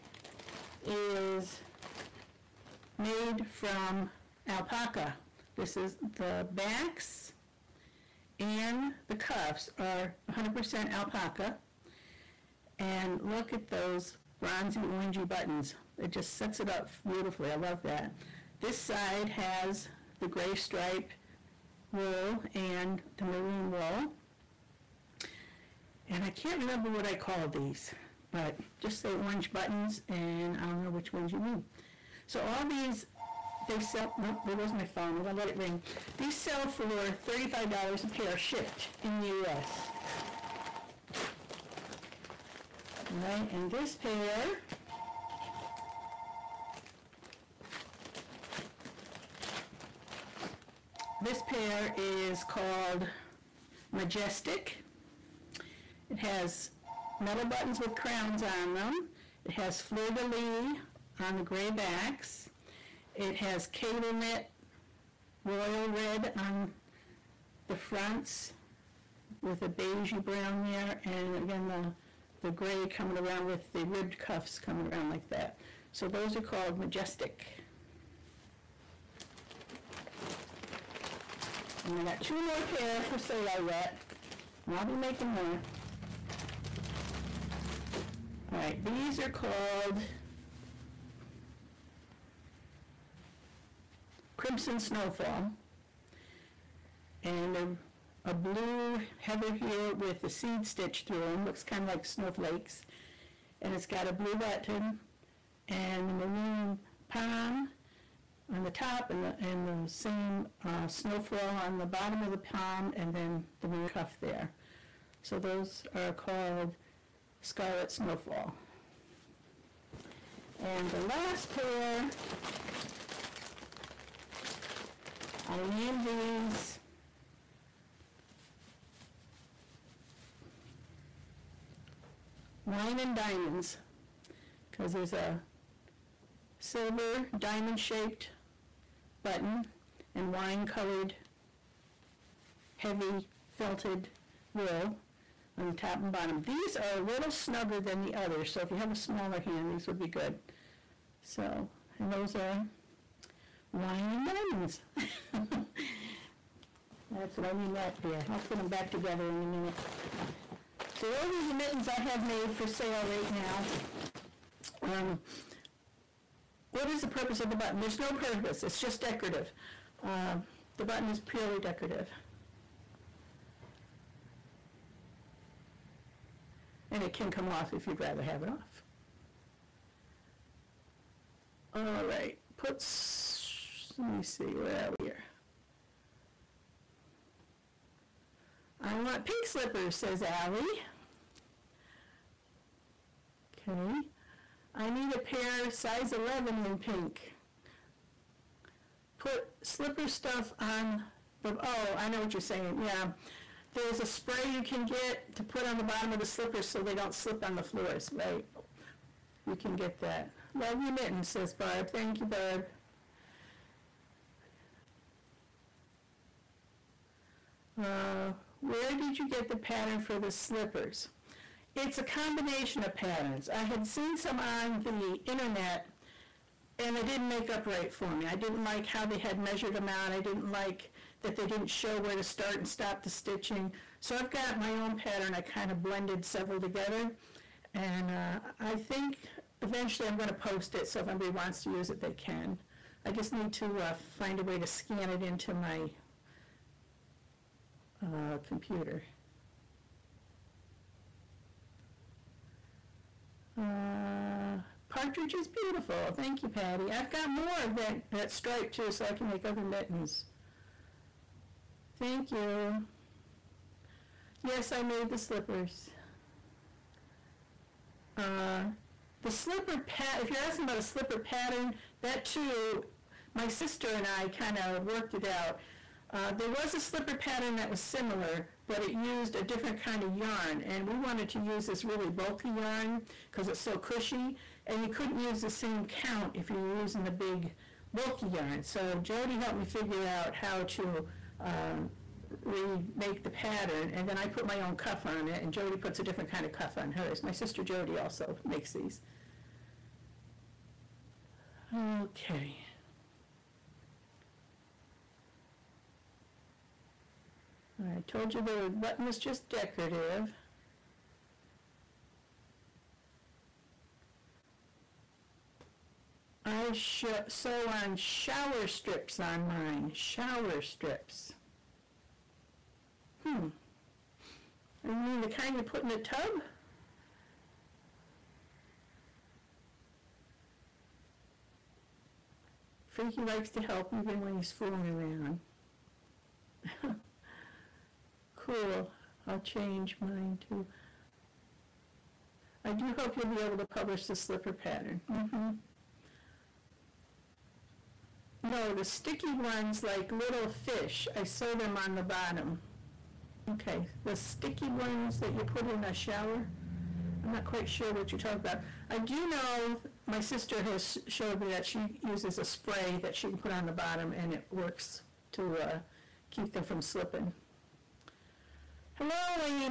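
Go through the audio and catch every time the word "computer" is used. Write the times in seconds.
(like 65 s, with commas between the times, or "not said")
248 s.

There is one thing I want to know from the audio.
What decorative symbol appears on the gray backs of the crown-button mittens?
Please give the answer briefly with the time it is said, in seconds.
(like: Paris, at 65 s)
fleur-de-lis, at 59 s.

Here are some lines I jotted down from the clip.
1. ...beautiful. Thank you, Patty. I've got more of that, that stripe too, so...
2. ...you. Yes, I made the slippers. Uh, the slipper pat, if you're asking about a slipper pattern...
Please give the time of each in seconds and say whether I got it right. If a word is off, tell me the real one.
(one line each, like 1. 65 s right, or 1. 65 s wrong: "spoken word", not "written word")
1. 255 s right
2. 262 s right.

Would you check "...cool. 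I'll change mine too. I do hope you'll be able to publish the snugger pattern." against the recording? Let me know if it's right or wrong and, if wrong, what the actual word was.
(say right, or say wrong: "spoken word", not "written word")
wrong: "slipper", not "snugger".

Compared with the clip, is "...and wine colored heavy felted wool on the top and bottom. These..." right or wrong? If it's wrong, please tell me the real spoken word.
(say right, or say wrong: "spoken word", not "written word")
right.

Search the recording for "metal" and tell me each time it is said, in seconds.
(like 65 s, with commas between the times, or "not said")
57 s.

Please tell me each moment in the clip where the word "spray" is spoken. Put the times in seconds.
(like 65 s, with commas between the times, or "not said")
204 s, 362 s.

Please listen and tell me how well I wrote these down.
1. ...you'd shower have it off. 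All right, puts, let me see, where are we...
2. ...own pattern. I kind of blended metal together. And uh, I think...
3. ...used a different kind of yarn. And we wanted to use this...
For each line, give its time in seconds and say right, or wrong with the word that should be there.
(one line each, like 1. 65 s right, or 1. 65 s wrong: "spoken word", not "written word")
1. 177 s wrong: "rather", not "shower"
2. 234 s wrong: "several", not "metal"
3. 278 s right.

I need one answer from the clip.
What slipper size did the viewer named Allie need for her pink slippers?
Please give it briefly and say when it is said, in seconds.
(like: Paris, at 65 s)
11, at 196 s.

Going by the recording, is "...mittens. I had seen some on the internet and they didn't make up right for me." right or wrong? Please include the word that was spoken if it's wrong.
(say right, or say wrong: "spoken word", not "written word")
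wrong: "patterns", not "mittens".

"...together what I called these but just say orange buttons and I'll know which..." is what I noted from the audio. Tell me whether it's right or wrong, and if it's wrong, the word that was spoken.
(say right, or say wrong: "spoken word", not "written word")
wrong: "remember", not "together".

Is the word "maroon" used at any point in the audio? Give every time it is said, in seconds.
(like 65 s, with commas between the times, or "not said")
23 s, 106 s, 113 s.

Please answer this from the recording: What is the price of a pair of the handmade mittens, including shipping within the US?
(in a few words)
$35.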